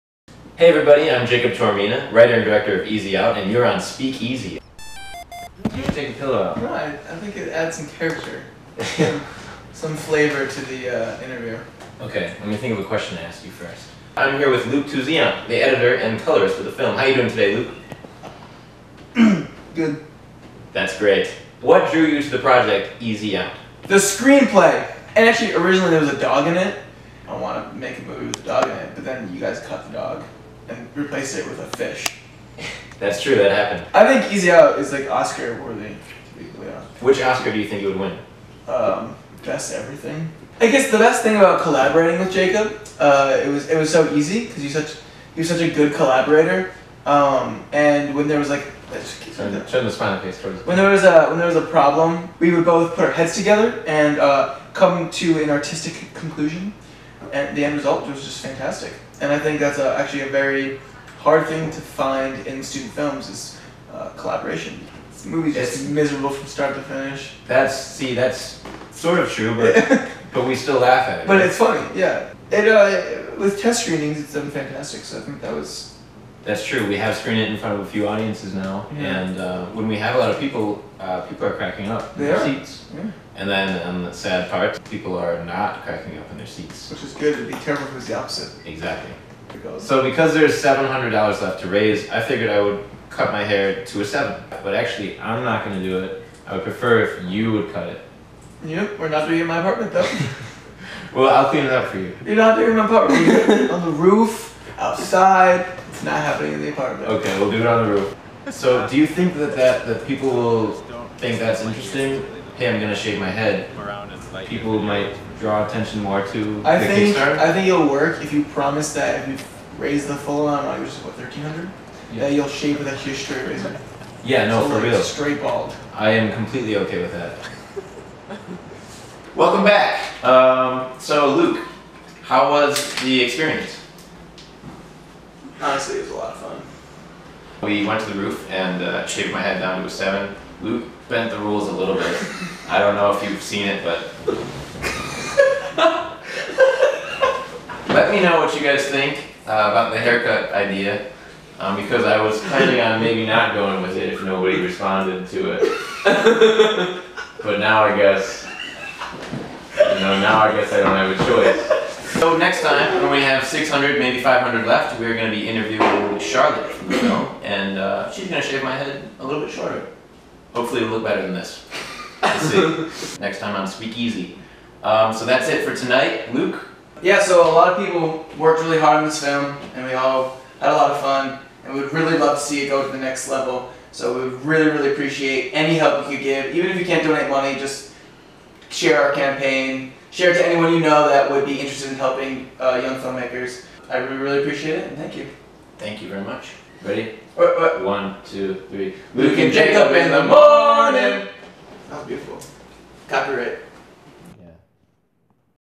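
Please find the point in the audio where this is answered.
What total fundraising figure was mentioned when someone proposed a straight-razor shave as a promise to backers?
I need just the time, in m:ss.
2:01.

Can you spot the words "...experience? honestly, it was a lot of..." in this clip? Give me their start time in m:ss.
2:13.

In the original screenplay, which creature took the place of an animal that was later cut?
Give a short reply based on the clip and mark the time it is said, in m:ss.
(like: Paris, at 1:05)
fish, at 0:31.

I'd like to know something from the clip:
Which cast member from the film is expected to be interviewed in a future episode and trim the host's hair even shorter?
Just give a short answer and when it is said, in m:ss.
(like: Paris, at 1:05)
Charlotte, at 2:46.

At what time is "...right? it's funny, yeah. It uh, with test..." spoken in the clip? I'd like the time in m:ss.
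1:11.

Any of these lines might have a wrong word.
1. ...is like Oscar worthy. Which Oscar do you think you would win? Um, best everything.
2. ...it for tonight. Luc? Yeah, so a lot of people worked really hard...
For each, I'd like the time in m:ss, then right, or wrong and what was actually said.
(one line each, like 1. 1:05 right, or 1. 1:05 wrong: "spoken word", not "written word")
1. 0:34 right
2. 2:55 right.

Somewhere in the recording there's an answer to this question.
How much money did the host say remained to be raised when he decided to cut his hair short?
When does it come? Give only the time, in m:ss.
1:30.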